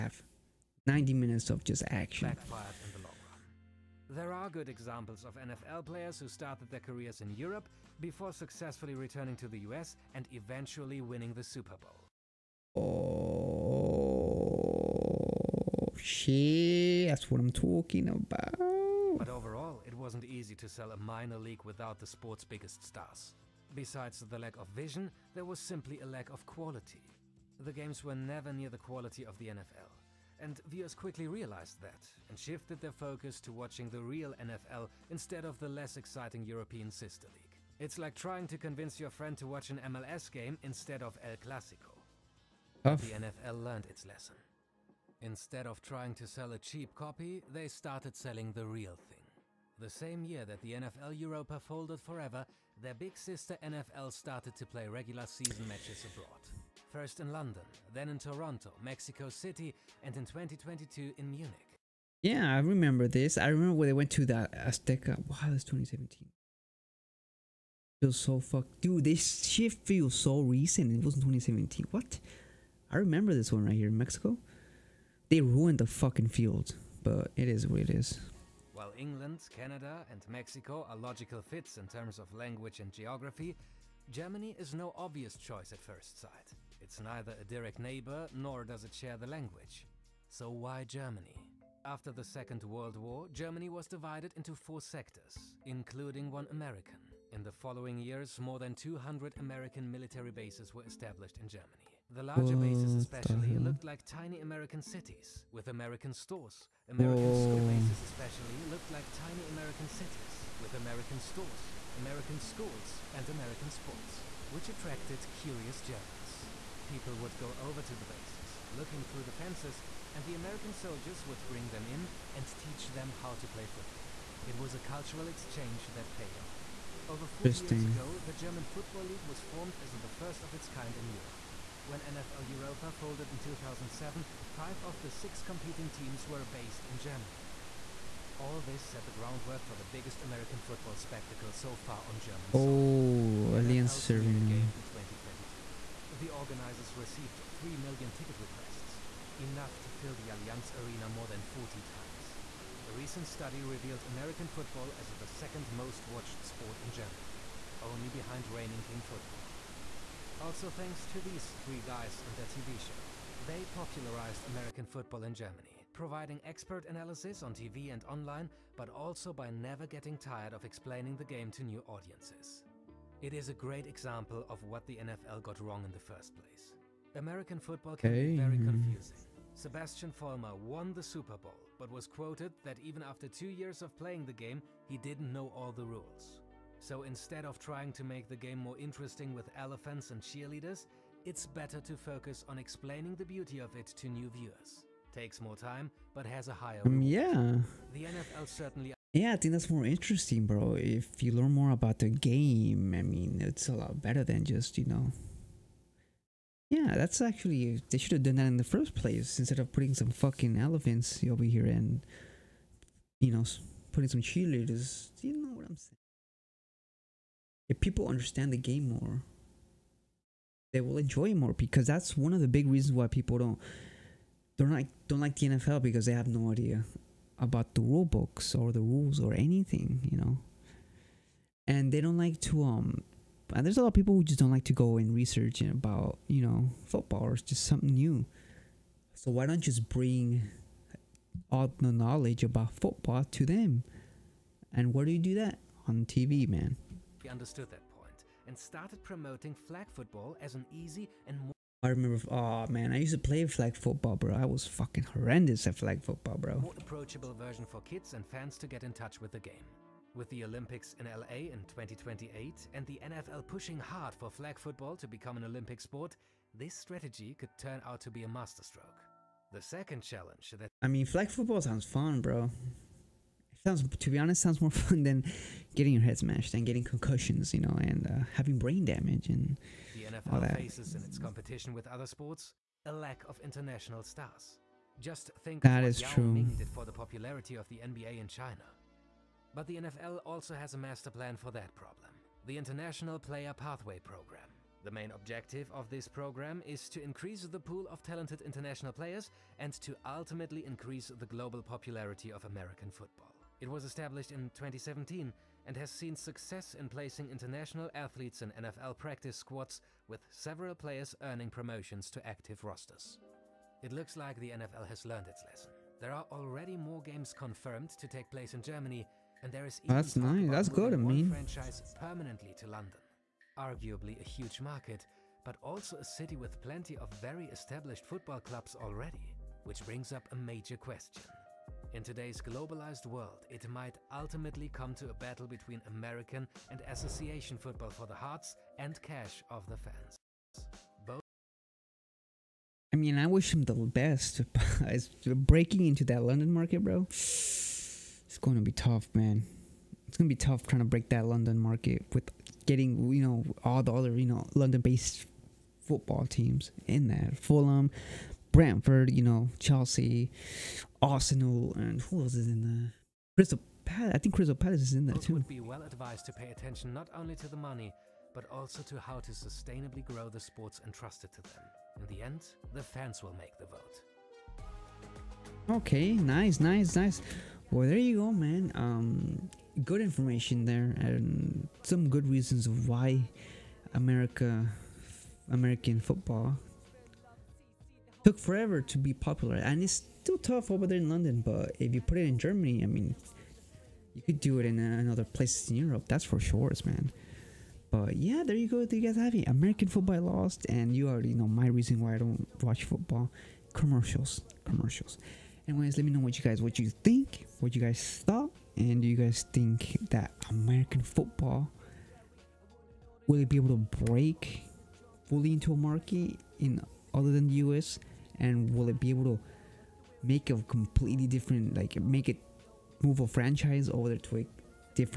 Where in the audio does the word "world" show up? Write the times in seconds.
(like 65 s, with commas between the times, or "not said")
92 s, 333 s.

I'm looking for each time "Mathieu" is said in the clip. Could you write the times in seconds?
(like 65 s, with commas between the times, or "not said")
not said.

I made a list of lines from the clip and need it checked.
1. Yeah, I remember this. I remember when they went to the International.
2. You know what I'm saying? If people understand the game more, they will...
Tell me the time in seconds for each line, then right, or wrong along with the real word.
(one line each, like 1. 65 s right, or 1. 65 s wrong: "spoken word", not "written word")
1. 62 s wrong: "Azteca", not "International"
2. 215 s right.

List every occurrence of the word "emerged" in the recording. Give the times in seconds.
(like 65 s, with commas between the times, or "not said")
not said.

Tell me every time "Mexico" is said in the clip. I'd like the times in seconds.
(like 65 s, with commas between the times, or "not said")
58 s, 73 s, 80 s.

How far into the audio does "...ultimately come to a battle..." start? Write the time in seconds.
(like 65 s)
334 s.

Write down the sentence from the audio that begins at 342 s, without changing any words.
I mean, I wish him the best.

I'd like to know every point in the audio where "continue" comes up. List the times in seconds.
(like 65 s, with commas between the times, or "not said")
not said.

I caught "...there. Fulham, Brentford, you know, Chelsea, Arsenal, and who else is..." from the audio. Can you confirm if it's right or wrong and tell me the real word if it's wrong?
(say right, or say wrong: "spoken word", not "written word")
right.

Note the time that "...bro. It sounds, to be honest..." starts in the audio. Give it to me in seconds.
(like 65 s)
272 s.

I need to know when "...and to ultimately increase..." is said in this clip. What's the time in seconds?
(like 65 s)
299 s.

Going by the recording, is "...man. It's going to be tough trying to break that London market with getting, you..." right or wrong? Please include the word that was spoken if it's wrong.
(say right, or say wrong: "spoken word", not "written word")
right.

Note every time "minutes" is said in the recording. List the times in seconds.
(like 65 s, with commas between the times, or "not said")
1 s.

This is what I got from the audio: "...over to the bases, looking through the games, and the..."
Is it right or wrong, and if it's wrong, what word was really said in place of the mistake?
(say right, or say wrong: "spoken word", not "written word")
wrong: "fences", not "games".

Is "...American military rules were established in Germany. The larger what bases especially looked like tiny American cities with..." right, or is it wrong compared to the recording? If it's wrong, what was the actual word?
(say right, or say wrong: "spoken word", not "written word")
wrong: "bases", not "rules".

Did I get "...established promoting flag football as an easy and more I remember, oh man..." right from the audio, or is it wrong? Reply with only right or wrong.
wrong.